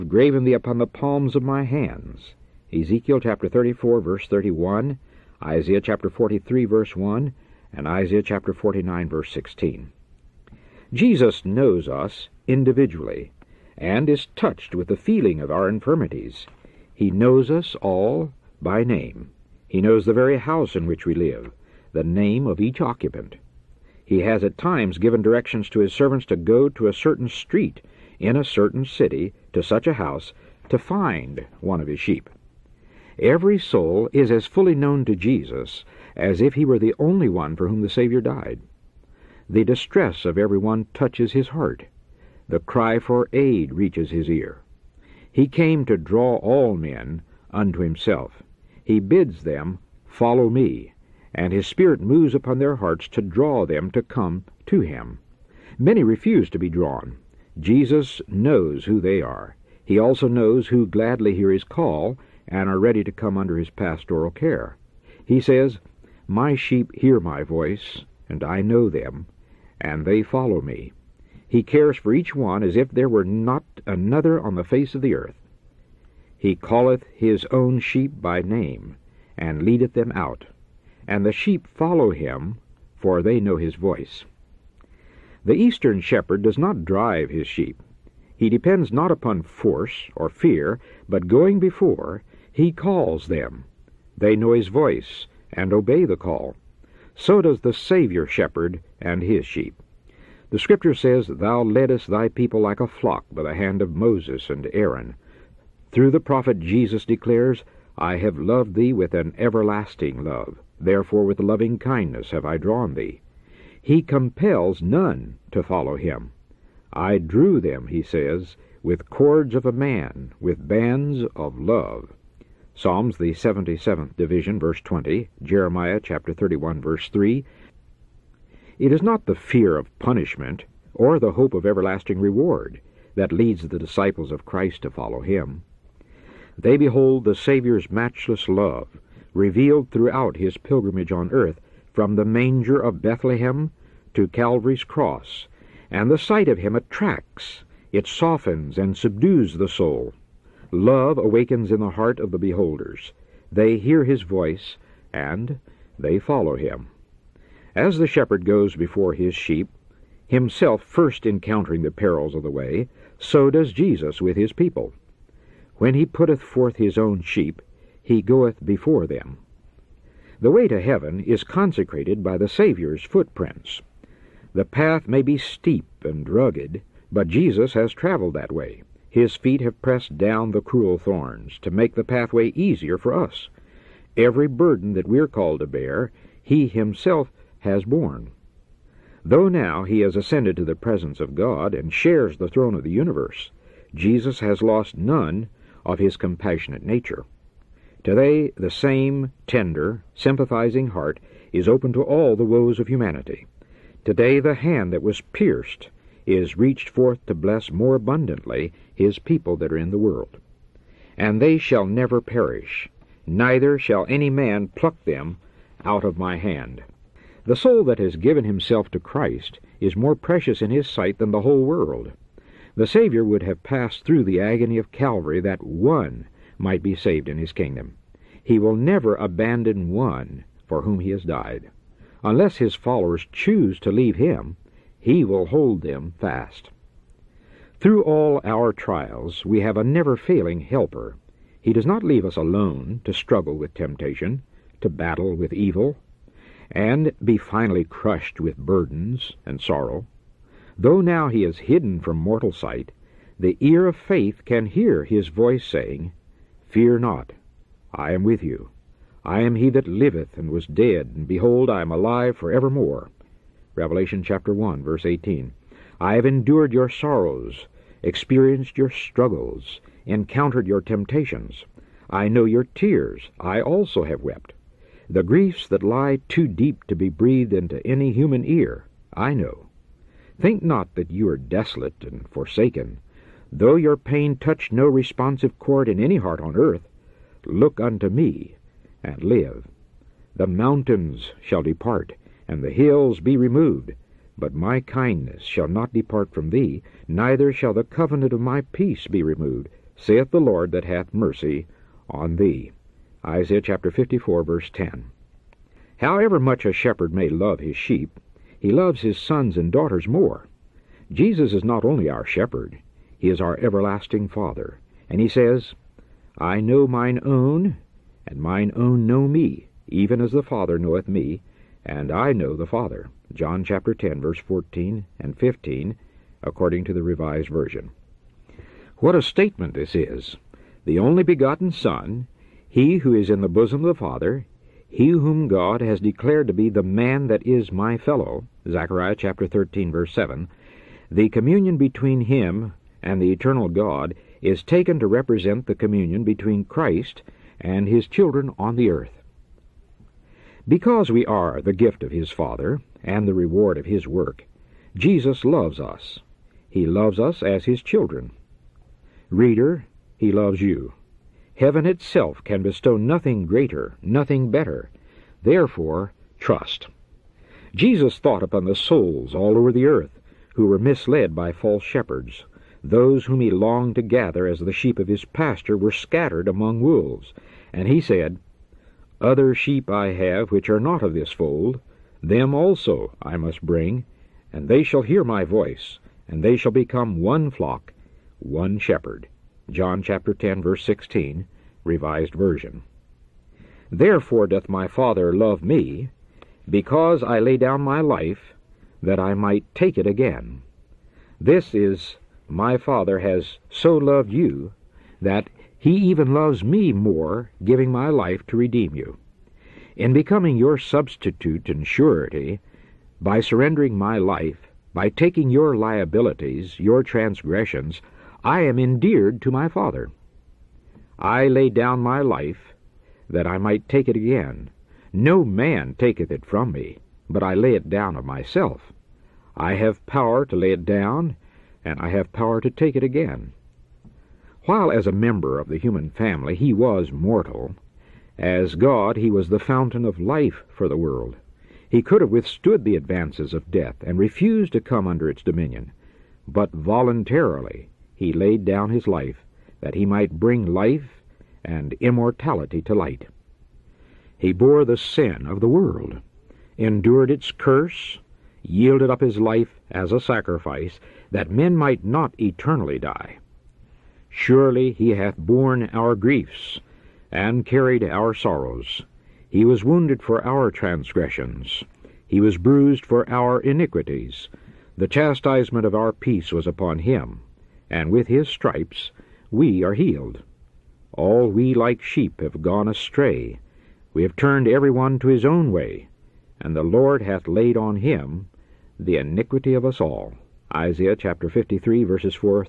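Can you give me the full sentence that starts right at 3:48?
He will never abandon one for whom he has died.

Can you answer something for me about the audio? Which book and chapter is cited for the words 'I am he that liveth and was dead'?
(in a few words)
Revelation chapter 1.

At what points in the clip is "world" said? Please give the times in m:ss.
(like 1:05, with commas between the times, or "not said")
3:29, 3:41, 7:20, 7:35.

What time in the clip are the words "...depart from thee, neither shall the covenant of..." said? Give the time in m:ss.
4:55.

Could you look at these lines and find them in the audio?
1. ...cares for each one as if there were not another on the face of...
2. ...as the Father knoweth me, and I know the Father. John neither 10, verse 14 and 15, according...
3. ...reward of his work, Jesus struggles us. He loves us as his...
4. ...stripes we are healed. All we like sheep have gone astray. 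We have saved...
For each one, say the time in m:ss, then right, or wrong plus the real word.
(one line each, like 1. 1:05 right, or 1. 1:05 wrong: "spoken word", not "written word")
1. 1:11 right
2. 5:20 wrong: "chapter", not "neither"
3. 5:53 wrong: "loves", not "struggles"
4. 7:58 wrong: "turned", not "saved".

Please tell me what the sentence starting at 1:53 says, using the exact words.
He compels none to follow him.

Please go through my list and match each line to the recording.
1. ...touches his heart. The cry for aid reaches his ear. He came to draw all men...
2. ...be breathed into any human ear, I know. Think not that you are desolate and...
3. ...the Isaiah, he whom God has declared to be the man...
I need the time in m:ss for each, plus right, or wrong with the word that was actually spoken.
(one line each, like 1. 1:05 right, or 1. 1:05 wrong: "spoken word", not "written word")
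1. 0:40 right
2. 4:36 right
3. 5:33 wrong: "Father", not "Isaiah".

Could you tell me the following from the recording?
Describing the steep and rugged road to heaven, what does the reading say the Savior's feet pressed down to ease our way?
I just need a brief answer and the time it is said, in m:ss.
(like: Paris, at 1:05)
the cruel thorns, at 3:00.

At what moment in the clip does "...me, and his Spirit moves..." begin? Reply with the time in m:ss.
0:50.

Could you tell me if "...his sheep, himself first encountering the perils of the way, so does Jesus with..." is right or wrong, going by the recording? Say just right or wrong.
right.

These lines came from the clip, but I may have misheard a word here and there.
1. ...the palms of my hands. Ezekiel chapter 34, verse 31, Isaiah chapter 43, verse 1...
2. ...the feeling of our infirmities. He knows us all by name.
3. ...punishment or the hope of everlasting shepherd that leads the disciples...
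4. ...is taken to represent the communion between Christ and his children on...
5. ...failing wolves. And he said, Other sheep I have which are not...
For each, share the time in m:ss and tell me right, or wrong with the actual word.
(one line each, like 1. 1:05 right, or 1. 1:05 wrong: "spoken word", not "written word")
1. 0:00 right
2. 0:14 right
3. 2:09 wrong: "reward", not "shepherd"
4. 5:44 right
5. 6:16 wrong: "among", not "failing".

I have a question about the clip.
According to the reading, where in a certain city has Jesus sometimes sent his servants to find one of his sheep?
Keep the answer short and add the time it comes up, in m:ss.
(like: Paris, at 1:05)
a certain street, at 0:26.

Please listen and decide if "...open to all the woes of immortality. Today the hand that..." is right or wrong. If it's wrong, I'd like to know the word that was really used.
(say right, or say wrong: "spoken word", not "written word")
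wrong: "humanity", not "immortality".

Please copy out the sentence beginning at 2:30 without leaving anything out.
Love awakens in the heart of the beholders.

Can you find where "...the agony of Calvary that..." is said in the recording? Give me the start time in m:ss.
3:44.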